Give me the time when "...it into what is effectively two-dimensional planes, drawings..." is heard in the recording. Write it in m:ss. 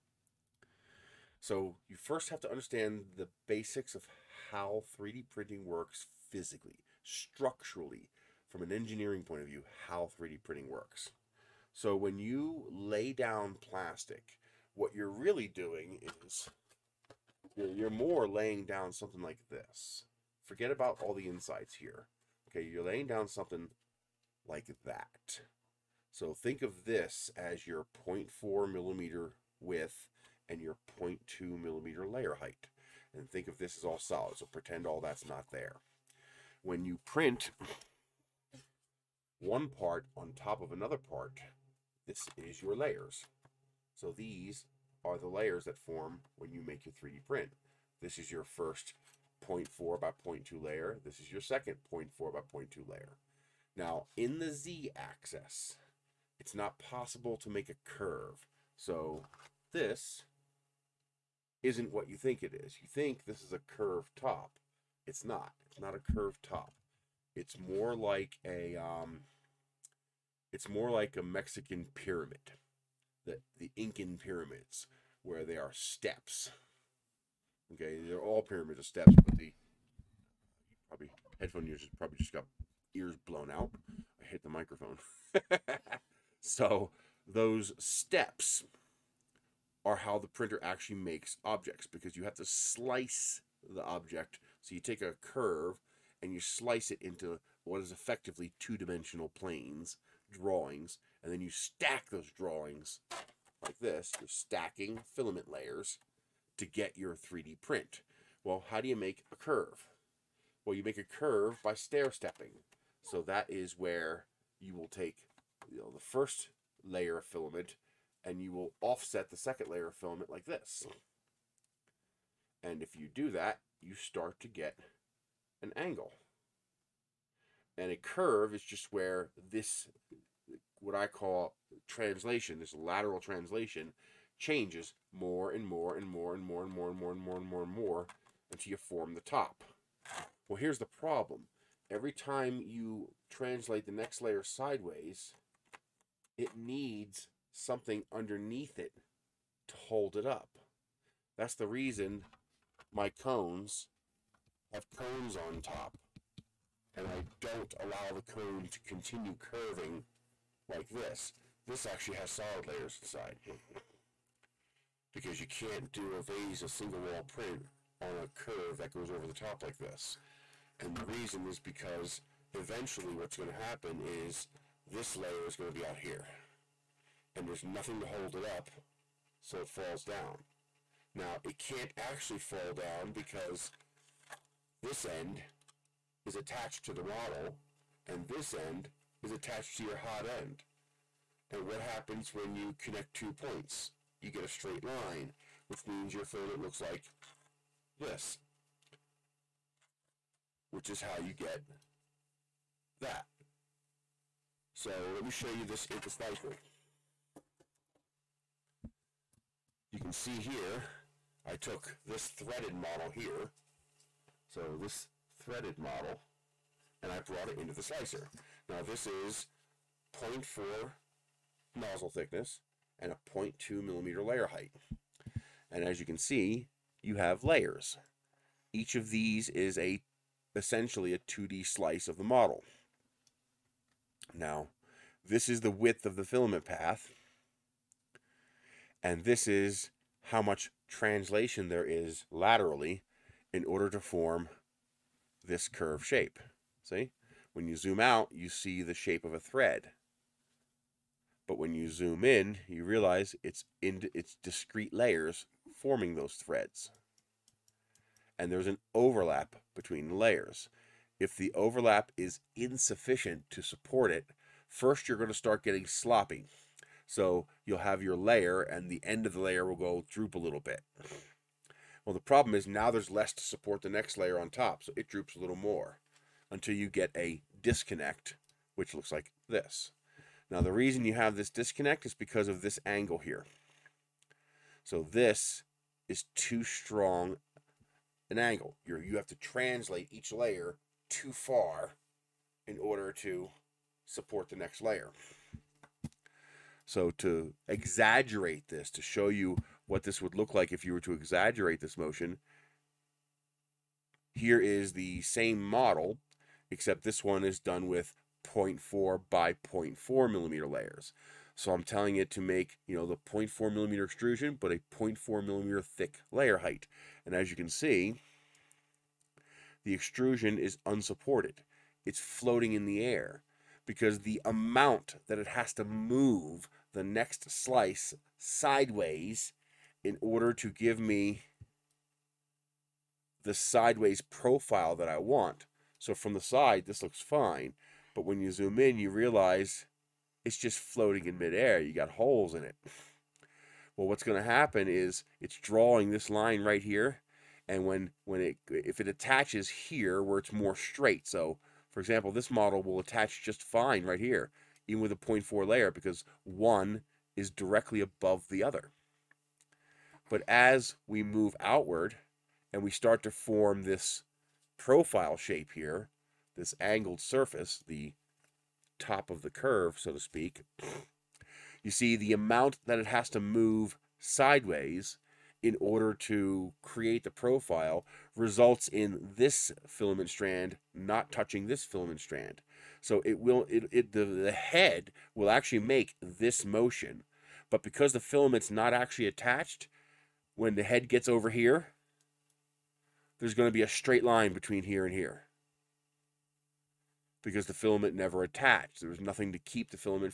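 1:36.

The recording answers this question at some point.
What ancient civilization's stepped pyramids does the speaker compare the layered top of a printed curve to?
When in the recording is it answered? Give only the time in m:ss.
1:13.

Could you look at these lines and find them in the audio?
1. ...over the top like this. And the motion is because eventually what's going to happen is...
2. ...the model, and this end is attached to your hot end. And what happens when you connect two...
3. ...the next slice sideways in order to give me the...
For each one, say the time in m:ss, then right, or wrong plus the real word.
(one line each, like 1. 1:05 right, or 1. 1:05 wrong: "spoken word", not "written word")
1. 2:49 wrong: "reason", not "motion"
2. 3:06 right
3. 5:26 right.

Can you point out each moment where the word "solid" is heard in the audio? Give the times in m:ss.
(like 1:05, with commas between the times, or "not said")
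0:33, 2:42.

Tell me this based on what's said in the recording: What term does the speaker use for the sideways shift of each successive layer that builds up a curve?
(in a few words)
lateral translation.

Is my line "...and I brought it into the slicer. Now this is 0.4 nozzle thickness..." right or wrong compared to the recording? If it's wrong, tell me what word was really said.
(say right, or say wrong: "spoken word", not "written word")
right.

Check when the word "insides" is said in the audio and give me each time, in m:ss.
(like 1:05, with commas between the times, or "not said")
0:21, 2:43.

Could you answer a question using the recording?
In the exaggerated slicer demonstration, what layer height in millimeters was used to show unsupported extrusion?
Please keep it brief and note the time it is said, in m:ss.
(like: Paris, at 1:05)
0.4, at 5:14.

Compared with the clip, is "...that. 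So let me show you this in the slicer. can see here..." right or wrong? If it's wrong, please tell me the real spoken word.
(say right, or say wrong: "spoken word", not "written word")
right.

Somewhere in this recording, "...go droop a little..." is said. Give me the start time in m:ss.
4:29.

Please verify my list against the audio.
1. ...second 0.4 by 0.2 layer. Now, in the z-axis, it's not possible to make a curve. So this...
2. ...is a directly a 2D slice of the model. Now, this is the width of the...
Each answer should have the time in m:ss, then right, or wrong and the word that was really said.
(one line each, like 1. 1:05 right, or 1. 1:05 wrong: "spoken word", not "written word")
1. 0:51 right
2. 3:49 wrong: "essentially", not "directly".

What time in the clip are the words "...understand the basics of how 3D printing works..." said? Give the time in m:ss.
0:02.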